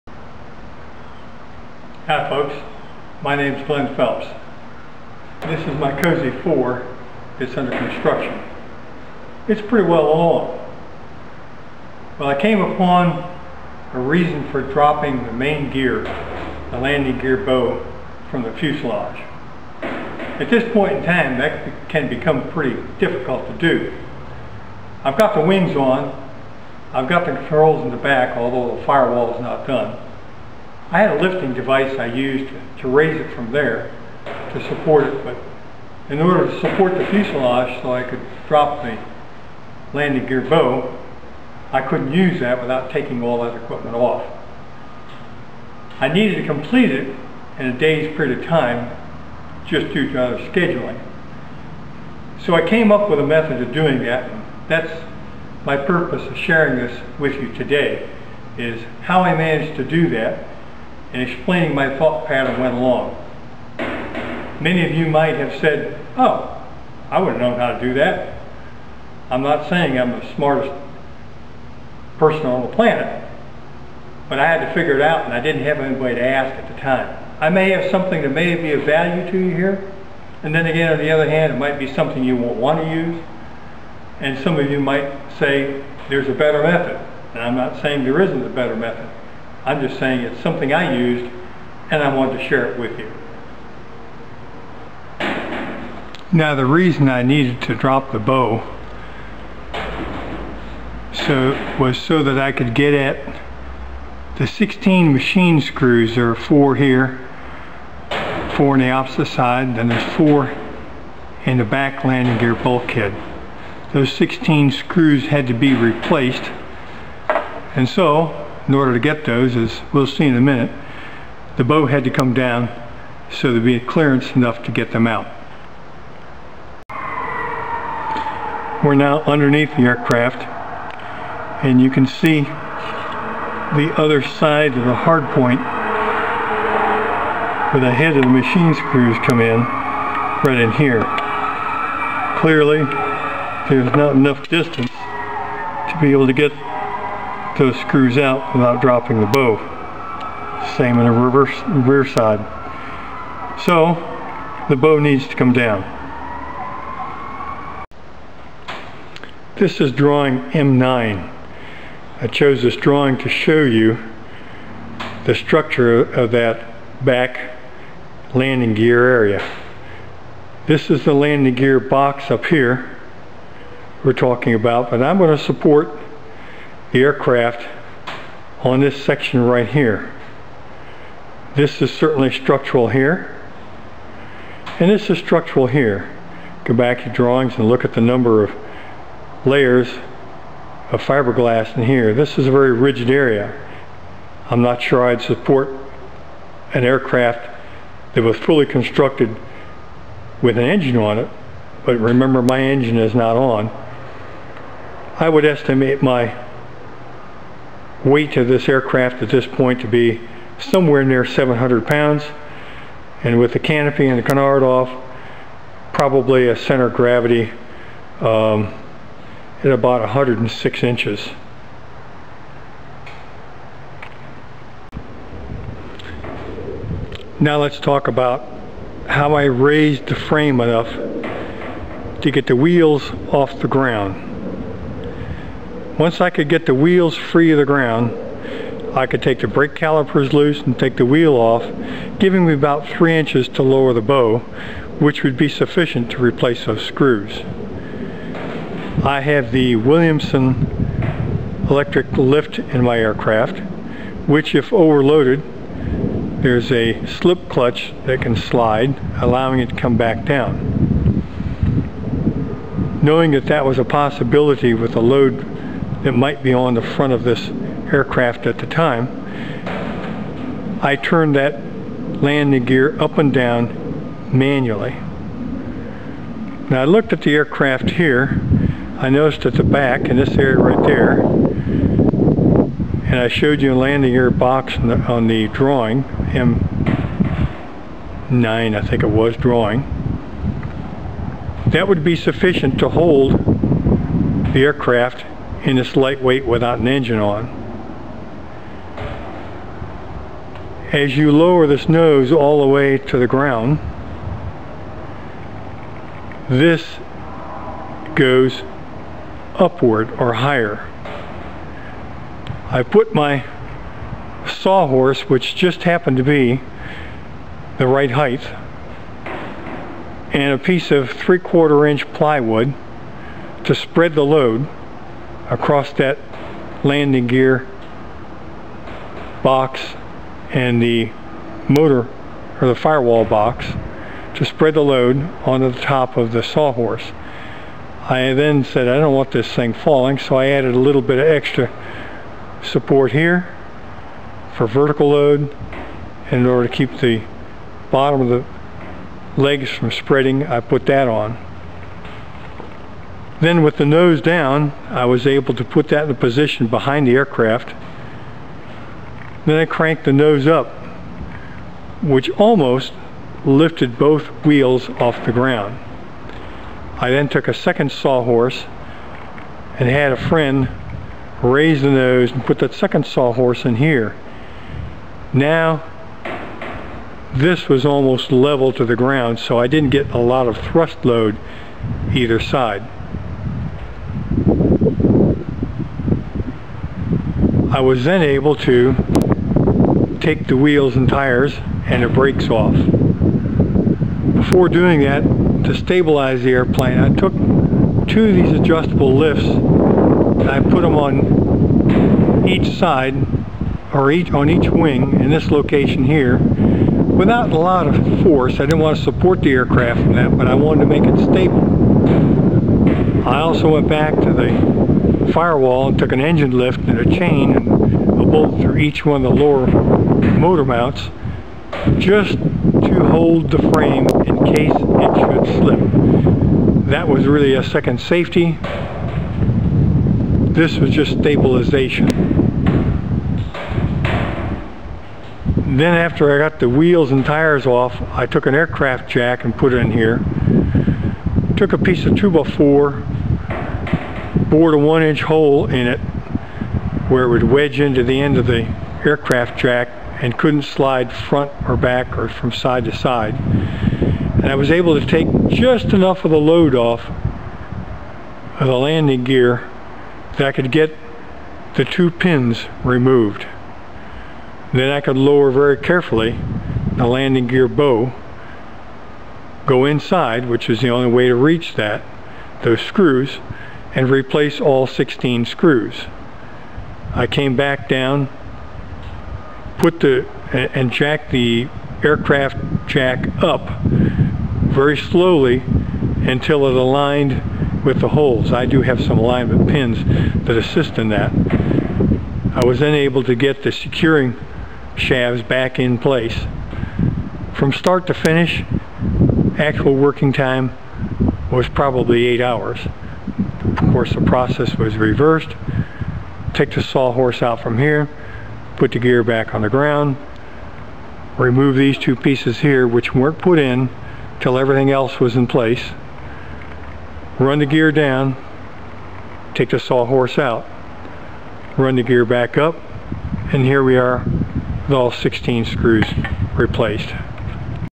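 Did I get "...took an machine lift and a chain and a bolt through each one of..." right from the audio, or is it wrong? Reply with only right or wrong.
wrong.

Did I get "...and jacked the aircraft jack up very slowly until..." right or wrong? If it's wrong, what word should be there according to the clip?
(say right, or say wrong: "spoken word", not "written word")
right.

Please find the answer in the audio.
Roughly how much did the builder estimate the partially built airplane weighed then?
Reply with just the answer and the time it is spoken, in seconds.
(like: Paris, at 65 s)
700 pounds, at 211 s.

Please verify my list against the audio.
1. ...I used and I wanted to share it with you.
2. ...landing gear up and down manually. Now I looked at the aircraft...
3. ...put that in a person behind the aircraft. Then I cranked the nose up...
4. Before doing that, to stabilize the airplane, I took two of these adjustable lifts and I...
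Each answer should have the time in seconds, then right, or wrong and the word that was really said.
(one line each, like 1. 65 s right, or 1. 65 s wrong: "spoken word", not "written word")
1. 90 s right
2. 272 s right
3. 355 s wrong: "position", not "person"
4. 394 s right.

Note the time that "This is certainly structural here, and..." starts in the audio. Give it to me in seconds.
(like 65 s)
181 s.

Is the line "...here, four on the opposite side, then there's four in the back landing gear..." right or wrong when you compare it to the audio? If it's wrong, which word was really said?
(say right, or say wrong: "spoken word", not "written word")
right.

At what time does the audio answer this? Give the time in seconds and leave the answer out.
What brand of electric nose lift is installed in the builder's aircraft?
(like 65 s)
249 s.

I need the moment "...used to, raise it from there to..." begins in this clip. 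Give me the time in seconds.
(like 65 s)
32 s.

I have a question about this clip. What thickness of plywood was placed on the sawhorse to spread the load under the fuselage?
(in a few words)
three-quarter inch.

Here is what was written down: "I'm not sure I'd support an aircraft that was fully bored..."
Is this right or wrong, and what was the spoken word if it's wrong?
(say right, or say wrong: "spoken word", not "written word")
wrong: "constructed", not "bored".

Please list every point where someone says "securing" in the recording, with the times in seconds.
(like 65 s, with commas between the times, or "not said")
493 s.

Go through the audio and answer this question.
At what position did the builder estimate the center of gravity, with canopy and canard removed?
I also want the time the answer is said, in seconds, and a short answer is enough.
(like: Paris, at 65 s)
106 inches, at 220 s.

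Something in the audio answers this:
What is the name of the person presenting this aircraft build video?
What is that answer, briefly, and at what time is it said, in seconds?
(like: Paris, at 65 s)
Glen Phelps, at 3 s.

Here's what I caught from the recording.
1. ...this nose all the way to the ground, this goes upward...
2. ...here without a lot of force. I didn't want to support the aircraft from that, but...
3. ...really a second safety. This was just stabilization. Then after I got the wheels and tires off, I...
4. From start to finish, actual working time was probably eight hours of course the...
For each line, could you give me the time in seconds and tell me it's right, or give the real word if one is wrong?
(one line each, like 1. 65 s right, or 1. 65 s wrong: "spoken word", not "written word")
1. 301 s right
2. 406 s right
3. 427 s right
4. 497 s right.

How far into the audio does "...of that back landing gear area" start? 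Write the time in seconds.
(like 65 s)
166 s.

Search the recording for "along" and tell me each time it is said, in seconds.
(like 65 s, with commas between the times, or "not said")
10 s, 62 s.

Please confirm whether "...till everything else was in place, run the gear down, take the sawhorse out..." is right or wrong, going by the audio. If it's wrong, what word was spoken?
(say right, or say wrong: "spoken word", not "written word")
right.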